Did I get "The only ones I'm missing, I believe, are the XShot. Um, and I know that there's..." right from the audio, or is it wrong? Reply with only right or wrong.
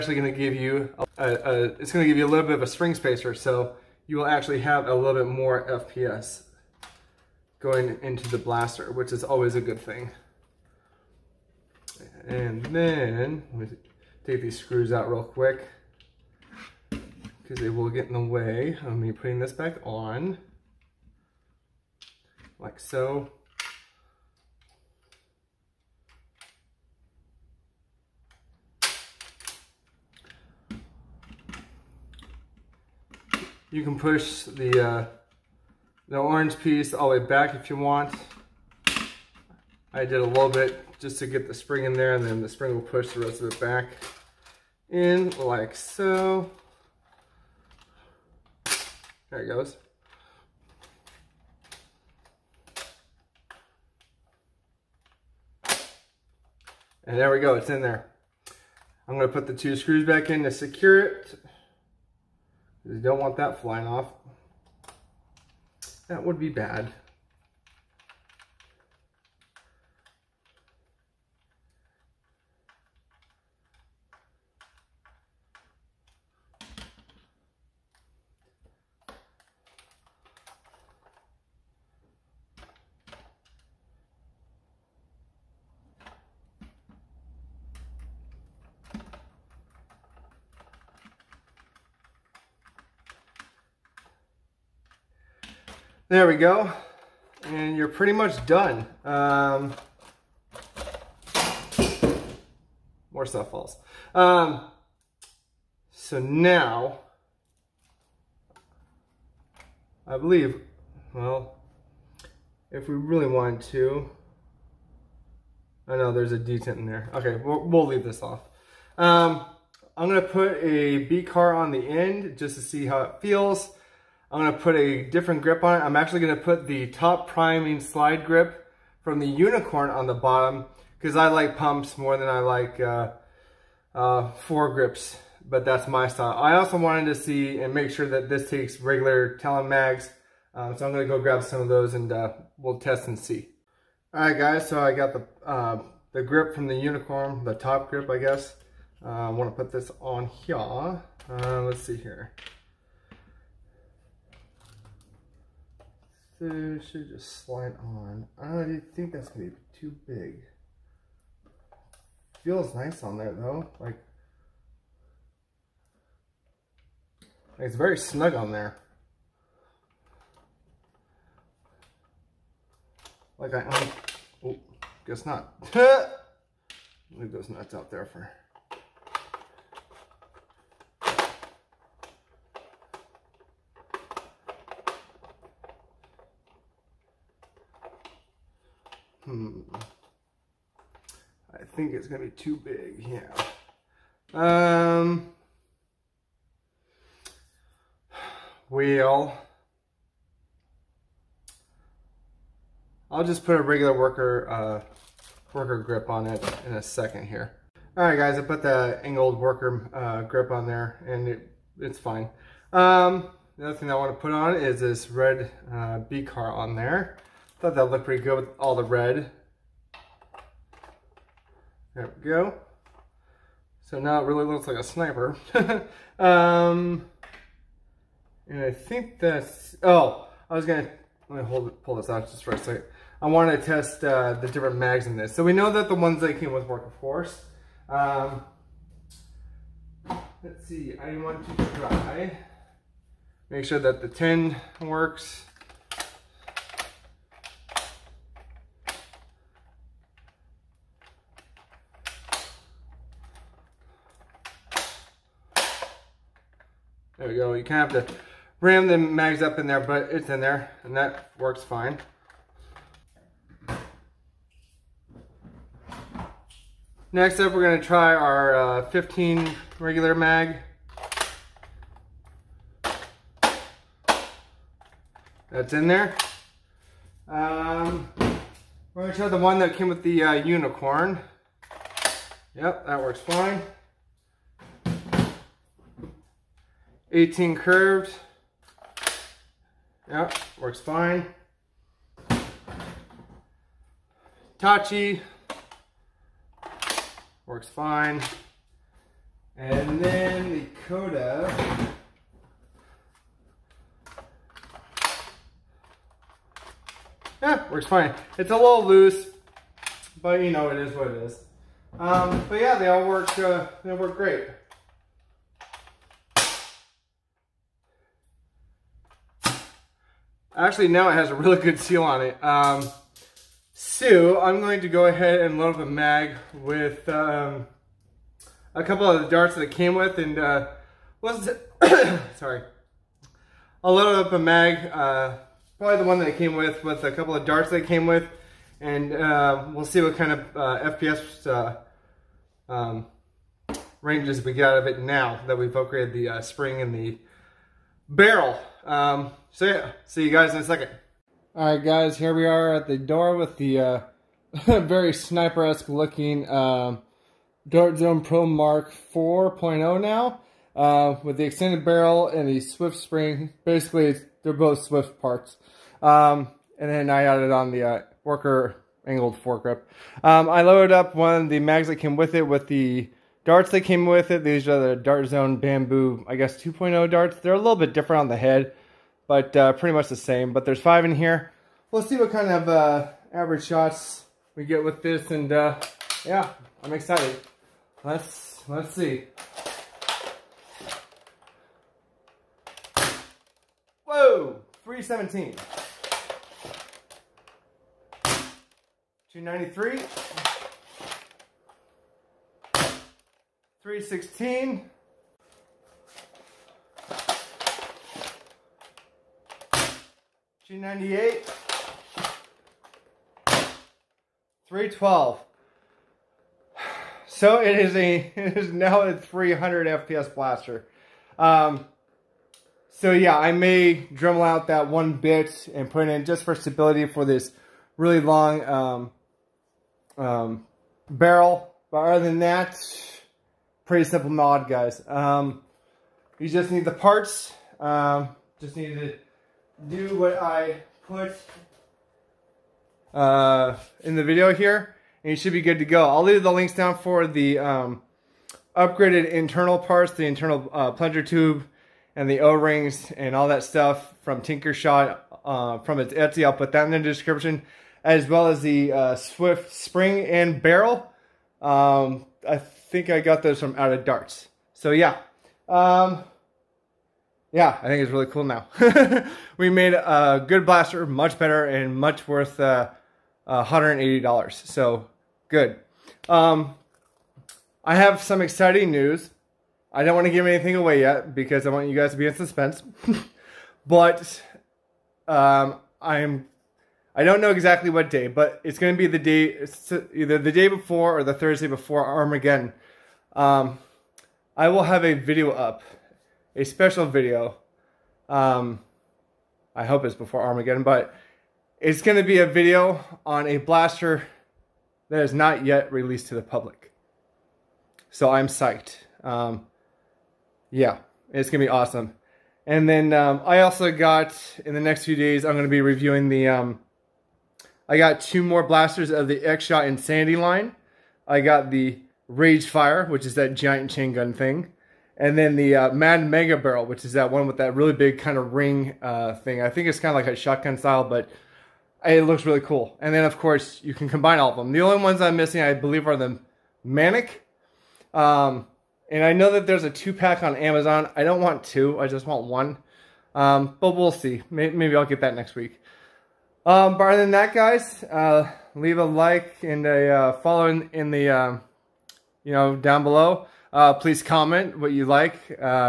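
wrong.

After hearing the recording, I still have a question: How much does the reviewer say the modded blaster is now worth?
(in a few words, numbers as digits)
$180.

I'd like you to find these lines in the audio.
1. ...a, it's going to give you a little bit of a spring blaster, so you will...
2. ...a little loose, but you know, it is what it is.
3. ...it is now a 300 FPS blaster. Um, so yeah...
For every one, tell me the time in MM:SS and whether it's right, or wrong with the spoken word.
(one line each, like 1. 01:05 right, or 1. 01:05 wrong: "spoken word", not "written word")
1. 00:01 wrong: "spacer", not "blaster"
2. 05:08 right
3. 06:58 right.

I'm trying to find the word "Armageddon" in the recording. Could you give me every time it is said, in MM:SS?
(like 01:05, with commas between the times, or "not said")
08:12, 08:20.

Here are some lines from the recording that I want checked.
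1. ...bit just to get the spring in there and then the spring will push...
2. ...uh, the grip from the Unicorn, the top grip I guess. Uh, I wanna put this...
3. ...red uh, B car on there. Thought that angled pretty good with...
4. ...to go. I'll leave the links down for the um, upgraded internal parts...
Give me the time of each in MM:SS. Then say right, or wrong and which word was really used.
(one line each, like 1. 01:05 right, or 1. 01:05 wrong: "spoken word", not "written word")
1. 00:40 right
2. 02:25 right
3. 03:35 wrong: "looked", not "angled"
4. 07:25 right.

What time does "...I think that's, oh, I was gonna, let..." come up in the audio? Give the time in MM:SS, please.
03:48.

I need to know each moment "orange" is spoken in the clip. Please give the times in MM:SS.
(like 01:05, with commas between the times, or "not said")
00:36.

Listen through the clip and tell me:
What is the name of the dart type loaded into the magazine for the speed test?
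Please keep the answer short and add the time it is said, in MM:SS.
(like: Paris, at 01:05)
Dart Zone Bamboo 2.0, at 06:14.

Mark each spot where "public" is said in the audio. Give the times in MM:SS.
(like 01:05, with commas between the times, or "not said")
08:26.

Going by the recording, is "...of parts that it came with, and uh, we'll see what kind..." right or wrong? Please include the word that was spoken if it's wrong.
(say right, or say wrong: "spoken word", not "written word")
wrong: "darts", not "parts".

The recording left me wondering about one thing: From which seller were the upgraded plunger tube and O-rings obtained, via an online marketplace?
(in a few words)
Tinkershot.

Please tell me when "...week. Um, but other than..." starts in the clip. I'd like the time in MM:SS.
09:05.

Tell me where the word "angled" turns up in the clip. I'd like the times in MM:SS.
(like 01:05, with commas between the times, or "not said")
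03:29, 06:09.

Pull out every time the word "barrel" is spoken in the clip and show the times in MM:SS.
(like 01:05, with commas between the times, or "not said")
05:48, 06:01, 07:11, 07:40, 08:46.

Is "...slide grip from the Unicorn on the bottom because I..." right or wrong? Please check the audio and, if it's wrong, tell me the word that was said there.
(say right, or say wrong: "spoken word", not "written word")
right.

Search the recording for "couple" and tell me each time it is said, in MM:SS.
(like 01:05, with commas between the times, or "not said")
05:28, 05:37.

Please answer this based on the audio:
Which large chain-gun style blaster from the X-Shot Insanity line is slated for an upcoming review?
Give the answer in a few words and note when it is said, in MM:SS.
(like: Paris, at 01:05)
Rage Fire, at 08:42.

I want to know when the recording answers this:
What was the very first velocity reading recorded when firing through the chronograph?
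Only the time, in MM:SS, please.
06:34.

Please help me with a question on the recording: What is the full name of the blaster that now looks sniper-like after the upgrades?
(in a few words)
Dart Zone Pro Mark 4.0.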